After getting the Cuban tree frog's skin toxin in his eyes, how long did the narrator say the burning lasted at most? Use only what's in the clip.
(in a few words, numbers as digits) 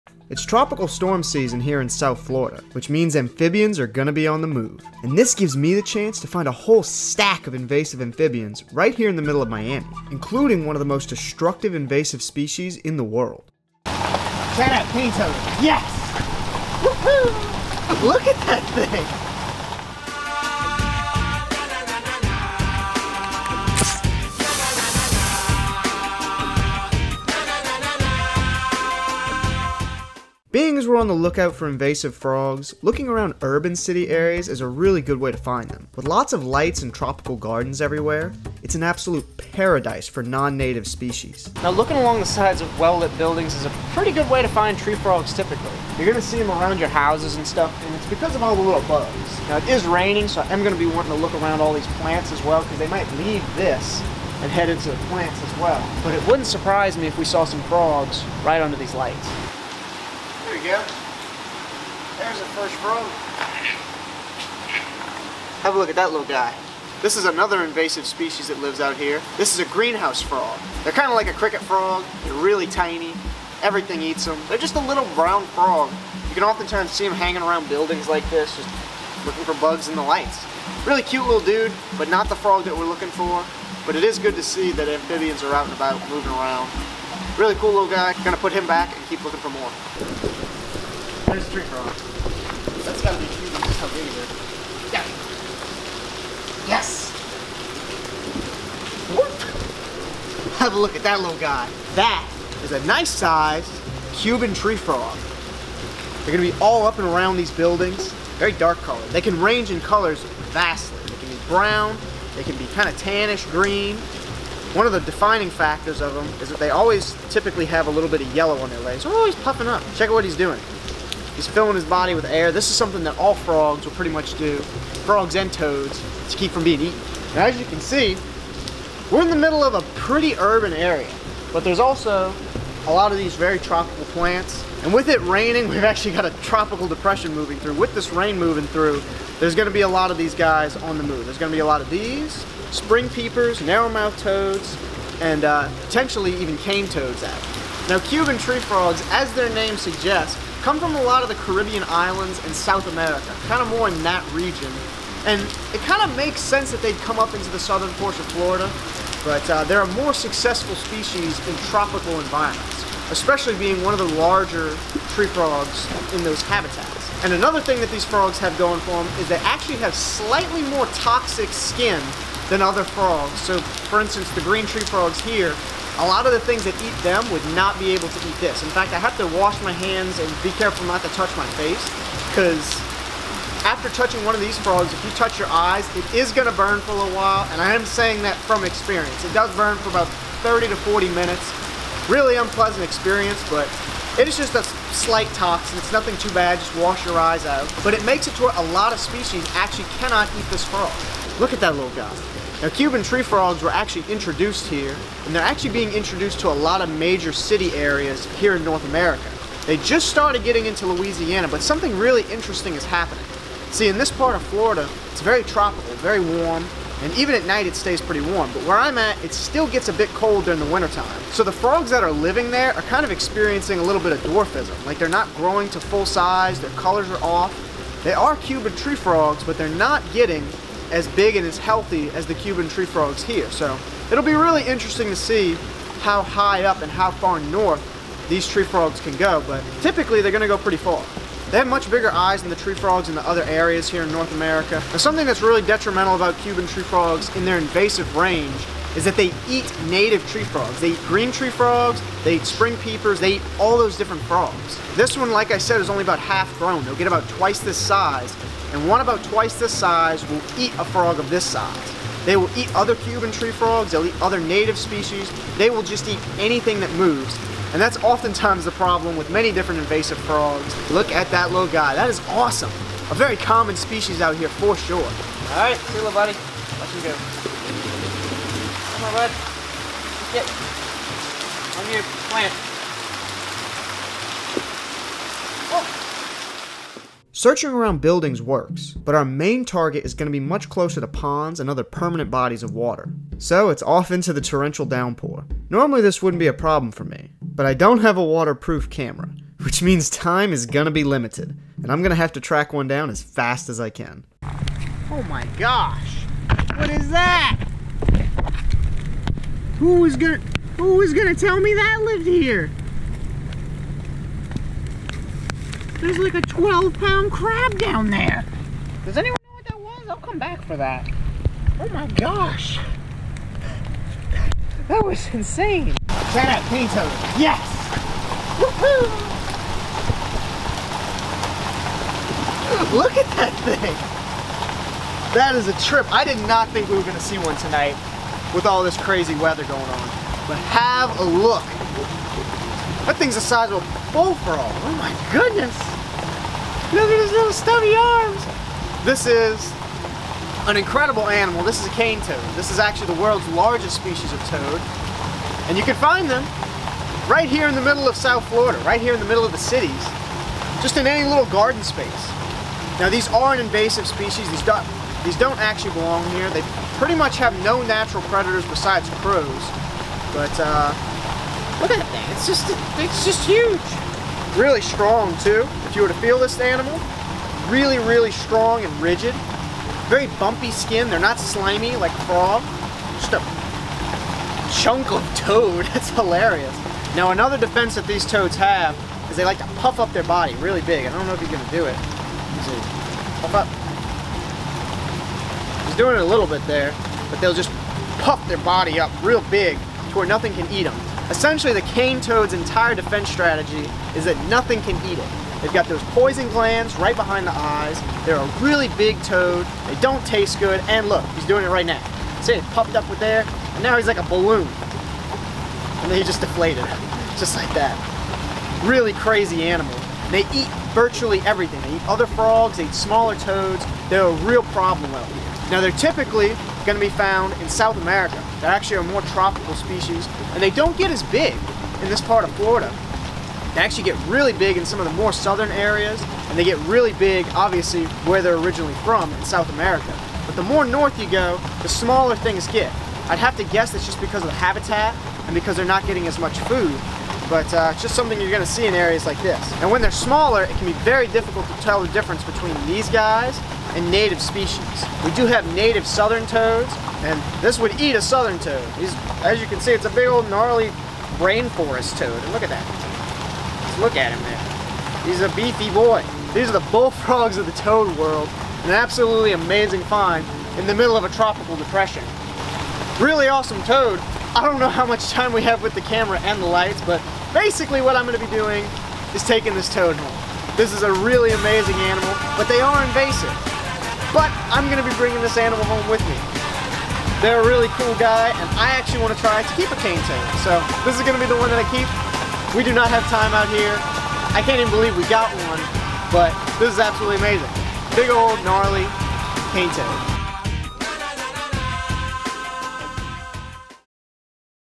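40 minutes.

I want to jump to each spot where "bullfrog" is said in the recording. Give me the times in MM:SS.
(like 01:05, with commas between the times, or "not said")
05:44, 07:46.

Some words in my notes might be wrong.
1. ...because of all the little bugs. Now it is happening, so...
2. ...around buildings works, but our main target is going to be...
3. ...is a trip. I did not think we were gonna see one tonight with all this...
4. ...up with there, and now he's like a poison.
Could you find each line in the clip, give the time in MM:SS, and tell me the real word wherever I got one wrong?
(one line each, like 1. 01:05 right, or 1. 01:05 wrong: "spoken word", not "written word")
1. 00:48 wrong: "raining", not "happening"
2. 04:47 right
3. 05:35 right
4. 06:52 wrong: "balloon", not "poison".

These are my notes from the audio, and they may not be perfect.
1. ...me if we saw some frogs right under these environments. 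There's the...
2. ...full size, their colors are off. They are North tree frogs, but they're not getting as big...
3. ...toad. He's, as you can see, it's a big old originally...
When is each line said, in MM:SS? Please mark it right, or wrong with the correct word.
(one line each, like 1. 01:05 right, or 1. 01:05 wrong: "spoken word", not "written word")
1. 00:56 wrong: "lights", not "environments"
2. 03:45 wrong: "Cuban", not "North"
3. 07:38 wrong: "gnarly", not "originally".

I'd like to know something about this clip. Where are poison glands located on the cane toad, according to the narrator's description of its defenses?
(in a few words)
Behind the eyes.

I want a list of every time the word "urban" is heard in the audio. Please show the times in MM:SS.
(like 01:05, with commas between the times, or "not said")
00:33, 02:10.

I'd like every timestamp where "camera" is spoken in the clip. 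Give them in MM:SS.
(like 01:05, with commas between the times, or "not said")
04:58, 07:56.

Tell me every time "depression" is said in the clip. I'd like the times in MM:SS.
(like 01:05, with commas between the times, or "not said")
02:16, 07:51.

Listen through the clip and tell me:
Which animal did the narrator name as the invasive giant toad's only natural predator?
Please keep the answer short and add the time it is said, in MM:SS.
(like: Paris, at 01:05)
Crows, at 06:09.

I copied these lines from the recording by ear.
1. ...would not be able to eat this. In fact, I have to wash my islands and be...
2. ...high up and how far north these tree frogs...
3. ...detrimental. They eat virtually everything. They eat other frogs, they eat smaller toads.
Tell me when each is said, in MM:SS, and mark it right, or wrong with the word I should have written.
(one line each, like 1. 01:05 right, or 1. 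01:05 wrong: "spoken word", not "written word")
1. 02:57 wrong: "hands", not "islands"
2. 03:56 right
3. 06:59 wrong: "animal", not "detrimental".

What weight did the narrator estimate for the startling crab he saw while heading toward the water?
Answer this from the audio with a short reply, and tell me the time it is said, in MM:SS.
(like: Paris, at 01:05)
12 pounds, at 05:16.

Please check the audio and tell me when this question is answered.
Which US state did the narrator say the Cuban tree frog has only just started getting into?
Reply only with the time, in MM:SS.
03:30.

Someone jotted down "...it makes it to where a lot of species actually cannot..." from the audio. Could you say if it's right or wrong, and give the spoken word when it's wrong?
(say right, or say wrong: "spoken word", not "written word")
right.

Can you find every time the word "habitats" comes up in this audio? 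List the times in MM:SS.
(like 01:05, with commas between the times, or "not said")
02:46, 07:24.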